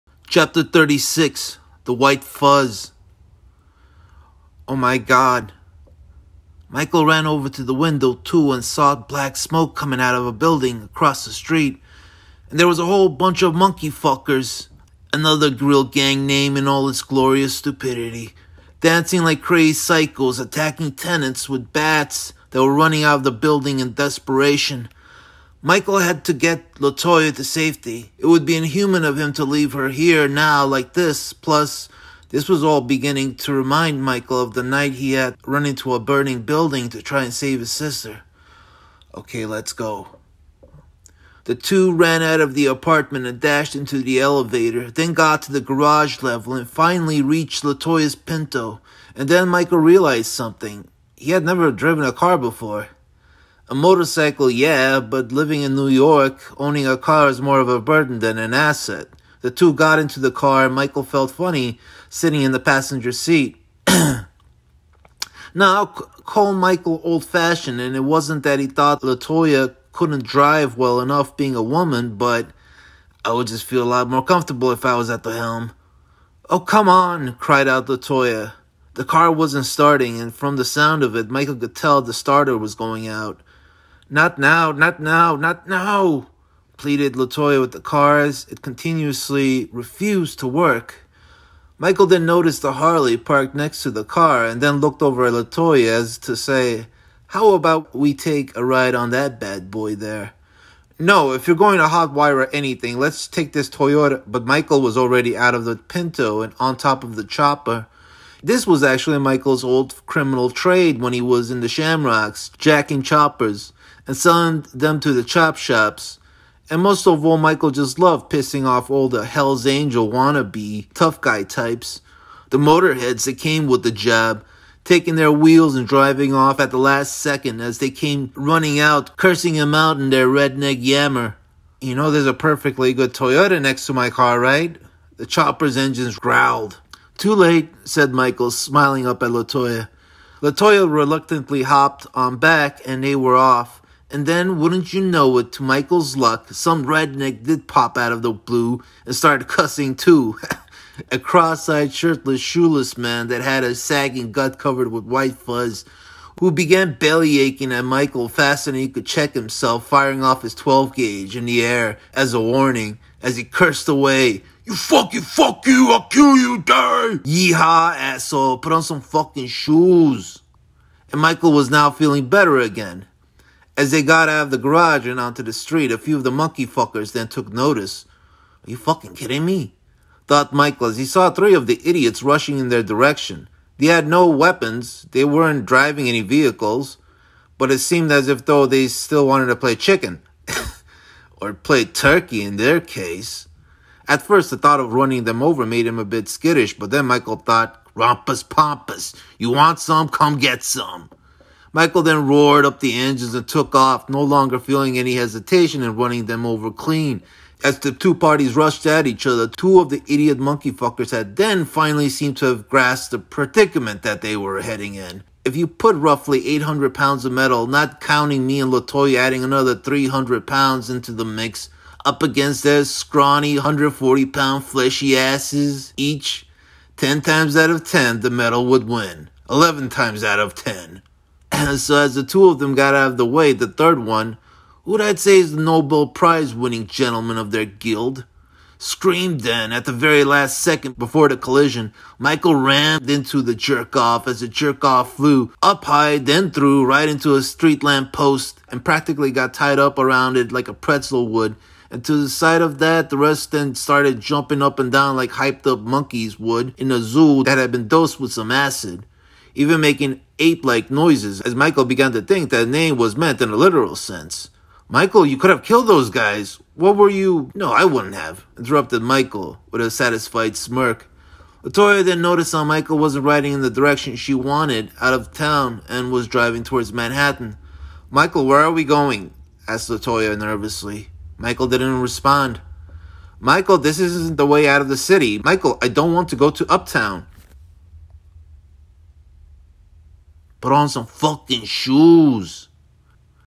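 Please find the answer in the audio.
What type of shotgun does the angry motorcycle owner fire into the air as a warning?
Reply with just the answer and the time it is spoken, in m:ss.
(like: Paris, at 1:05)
12 gauge, at 2:40.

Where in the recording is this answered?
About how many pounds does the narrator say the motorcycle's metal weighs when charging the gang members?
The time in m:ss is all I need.
3:36.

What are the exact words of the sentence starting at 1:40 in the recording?
No, if you're going to hotwire anything, let's take this Toyota.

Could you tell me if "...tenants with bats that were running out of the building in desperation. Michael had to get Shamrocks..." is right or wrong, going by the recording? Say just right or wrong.
wrong.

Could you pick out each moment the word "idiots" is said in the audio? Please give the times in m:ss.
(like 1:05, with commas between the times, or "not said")
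3:01, 3:30.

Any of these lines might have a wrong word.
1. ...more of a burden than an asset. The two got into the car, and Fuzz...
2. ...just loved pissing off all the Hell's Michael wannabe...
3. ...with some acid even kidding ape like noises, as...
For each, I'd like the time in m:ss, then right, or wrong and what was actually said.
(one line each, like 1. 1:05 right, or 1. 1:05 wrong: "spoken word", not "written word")
1. 0:57 wrong: "Michael", not "Fuzz"
2. 1:57 wrong: "Angel", not "Michael"
3. 4:18 wrong: "making", not "kidding".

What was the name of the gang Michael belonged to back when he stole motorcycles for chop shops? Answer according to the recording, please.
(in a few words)
Shamrocks.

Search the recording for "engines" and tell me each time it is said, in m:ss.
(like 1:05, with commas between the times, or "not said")
2:15, 3:22.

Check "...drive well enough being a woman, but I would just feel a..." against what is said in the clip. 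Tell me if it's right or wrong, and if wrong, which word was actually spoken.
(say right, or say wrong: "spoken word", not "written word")
right.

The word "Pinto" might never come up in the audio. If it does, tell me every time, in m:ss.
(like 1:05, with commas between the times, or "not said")
0:48, 1:45.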